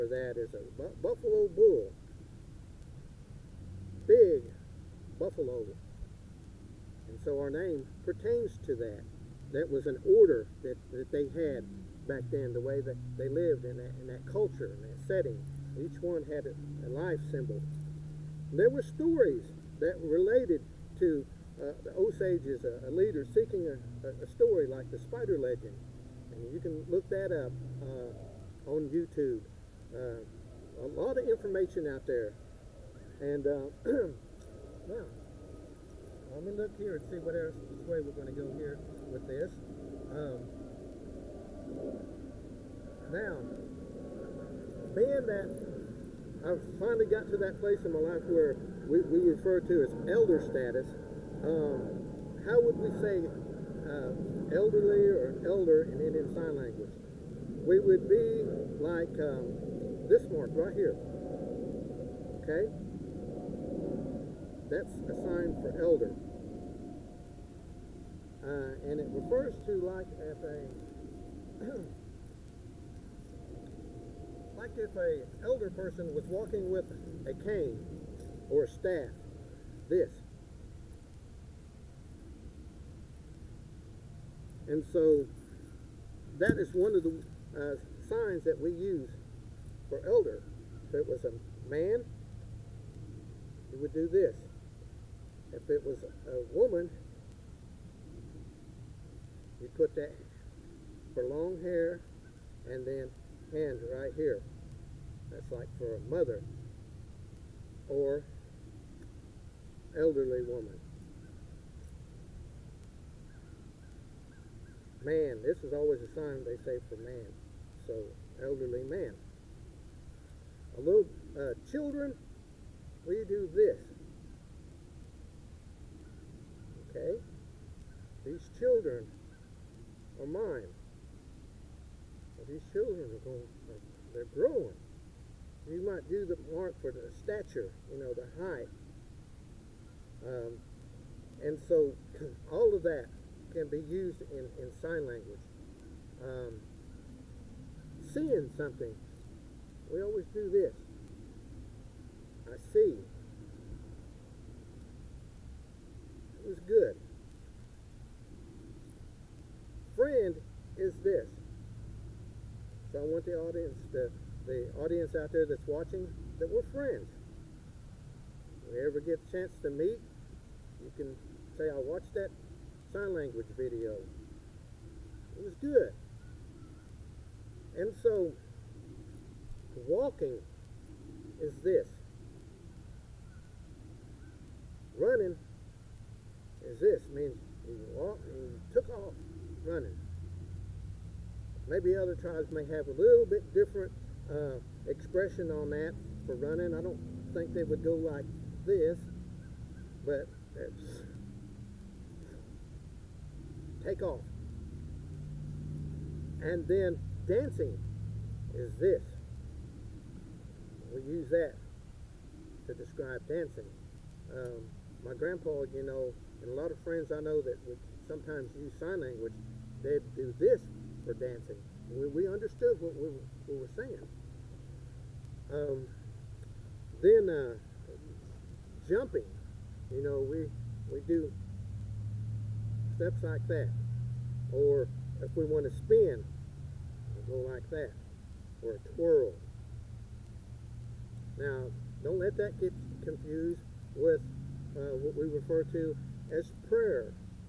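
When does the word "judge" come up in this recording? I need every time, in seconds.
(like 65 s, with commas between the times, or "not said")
not said.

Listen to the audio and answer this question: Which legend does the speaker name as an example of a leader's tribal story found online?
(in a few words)
the spider legend.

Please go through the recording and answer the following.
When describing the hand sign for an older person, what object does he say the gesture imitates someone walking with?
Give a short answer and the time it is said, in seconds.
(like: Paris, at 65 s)
a cane or a staff, at 77 s.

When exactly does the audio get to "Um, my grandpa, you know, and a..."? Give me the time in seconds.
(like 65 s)
214 s.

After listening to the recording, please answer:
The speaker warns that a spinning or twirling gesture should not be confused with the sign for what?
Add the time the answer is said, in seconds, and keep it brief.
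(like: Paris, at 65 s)
prayer, at 246 s.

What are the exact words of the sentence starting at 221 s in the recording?
We, we understood what we, we were saying.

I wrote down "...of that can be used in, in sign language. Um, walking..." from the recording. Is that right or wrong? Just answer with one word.
wrong.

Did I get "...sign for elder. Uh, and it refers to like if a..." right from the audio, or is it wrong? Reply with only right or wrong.
right.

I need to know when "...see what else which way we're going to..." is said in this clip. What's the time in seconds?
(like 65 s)
37 s.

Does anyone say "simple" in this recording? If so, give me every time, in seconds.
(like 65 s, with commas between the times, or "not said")
not said.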